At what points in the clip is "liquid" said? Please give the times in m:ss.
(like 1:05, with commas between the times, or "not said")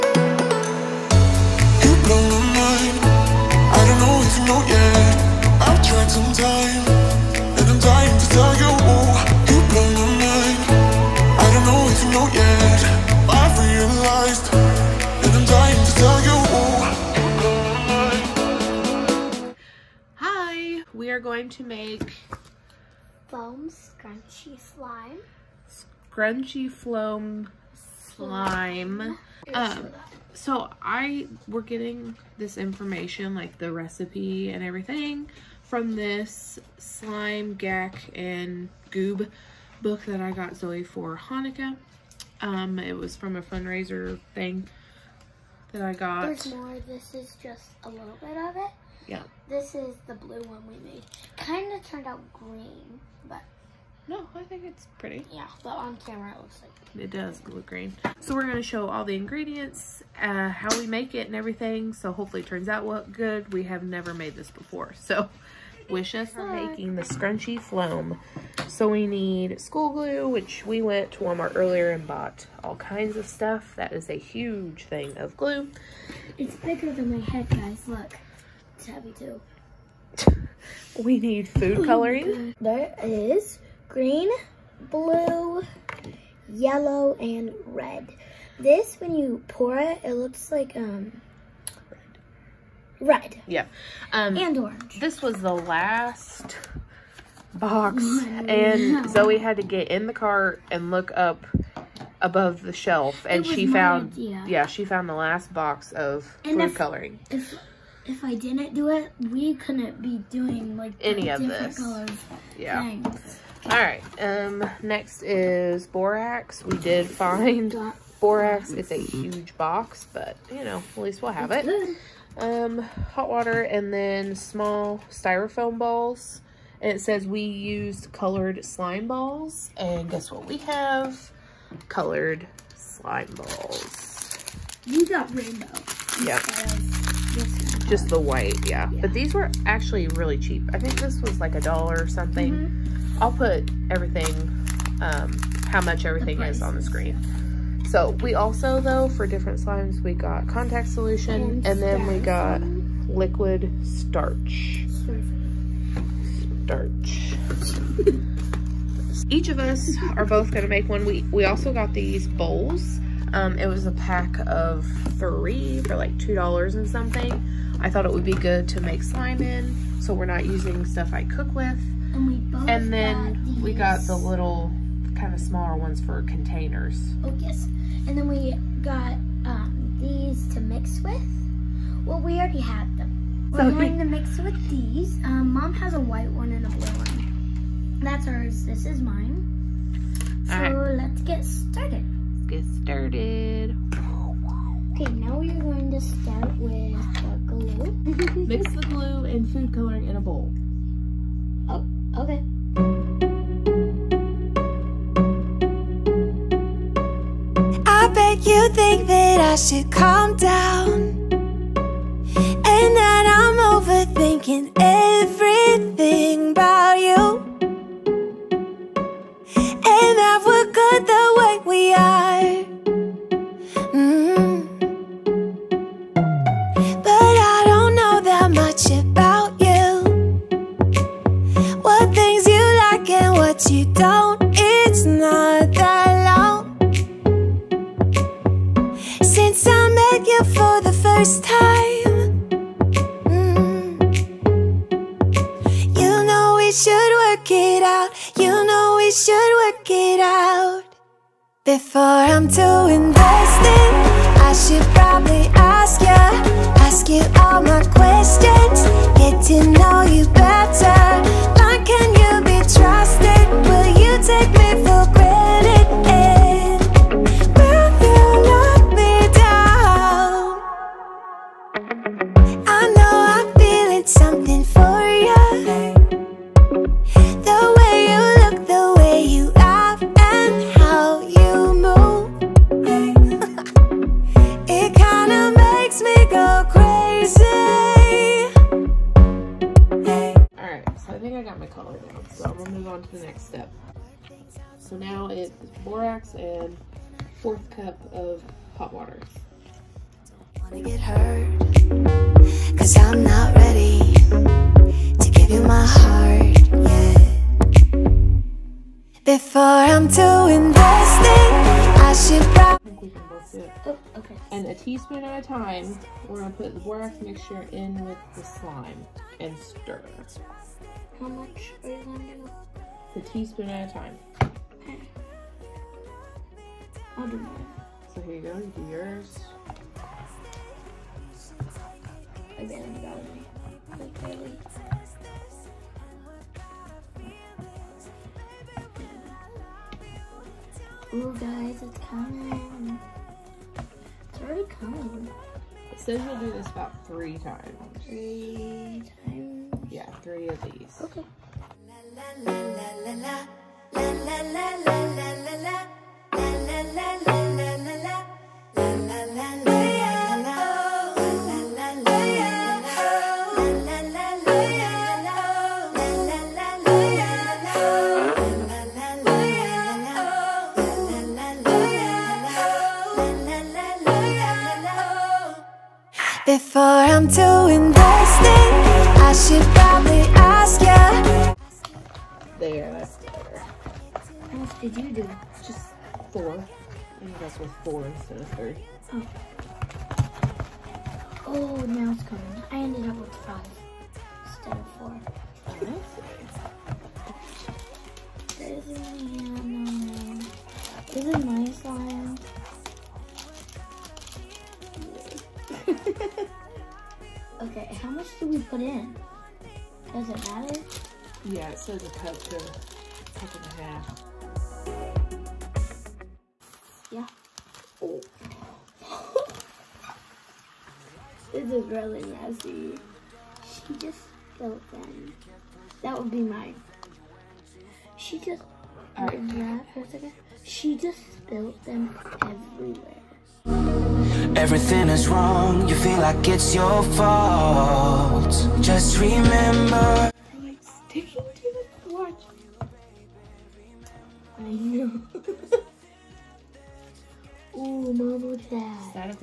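2:33.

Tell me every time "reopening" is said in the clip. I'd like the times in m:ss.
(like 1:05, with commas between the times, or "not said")
not said.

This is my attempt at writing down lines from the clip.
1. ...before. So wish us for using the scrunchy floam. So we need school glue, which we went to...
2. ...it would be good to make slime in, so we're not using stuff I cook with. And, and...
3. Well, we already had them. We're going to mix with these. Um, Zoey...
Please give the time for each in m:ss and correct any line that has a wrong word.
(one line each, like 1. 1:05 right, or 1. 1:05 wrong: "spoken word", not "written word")
1. 1:04 wrong: "making", not "using"
2. 2:48 right
3. 3:02 wrong: "Mom", not "Zoey".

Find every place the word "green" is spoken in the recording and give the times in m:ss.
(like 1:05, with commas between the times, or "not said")
0:52, 0:57, 1:23.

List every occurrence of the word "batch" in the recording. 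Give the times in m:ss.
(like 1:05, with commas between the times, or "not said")
not said.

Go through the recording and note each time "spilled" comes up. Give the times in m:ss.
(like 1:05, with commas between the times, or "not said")
7:04, 7:11.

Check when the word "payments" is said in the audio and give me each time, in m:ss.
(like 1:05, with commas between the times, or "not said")
not said.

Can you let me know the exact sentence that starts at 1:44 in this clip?
yeah she found the last box of and food if, coloring.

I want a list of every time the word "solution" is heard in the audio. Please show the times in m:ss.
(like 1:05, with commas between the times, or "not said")
2:30.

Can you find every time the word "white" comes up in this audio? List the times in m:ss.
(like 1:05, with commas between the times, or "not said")
2:18, 3:05.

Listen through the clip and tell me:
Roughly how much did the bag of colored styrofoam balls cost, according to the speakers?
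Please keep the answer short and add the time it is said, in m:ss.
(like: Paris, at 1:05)
$1, at 2:21.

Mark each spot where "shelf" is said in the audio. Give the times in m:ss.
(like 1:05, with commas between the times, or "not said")
1:42.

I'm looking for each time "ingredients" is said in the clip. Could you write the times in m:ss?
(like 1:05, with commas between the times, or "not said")
0:59.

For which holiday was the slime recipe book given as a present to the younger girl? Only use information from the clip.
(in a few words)
Hanukkah.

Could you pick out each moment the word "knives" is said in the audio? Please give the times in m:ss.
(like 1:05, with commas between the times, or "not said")
not said.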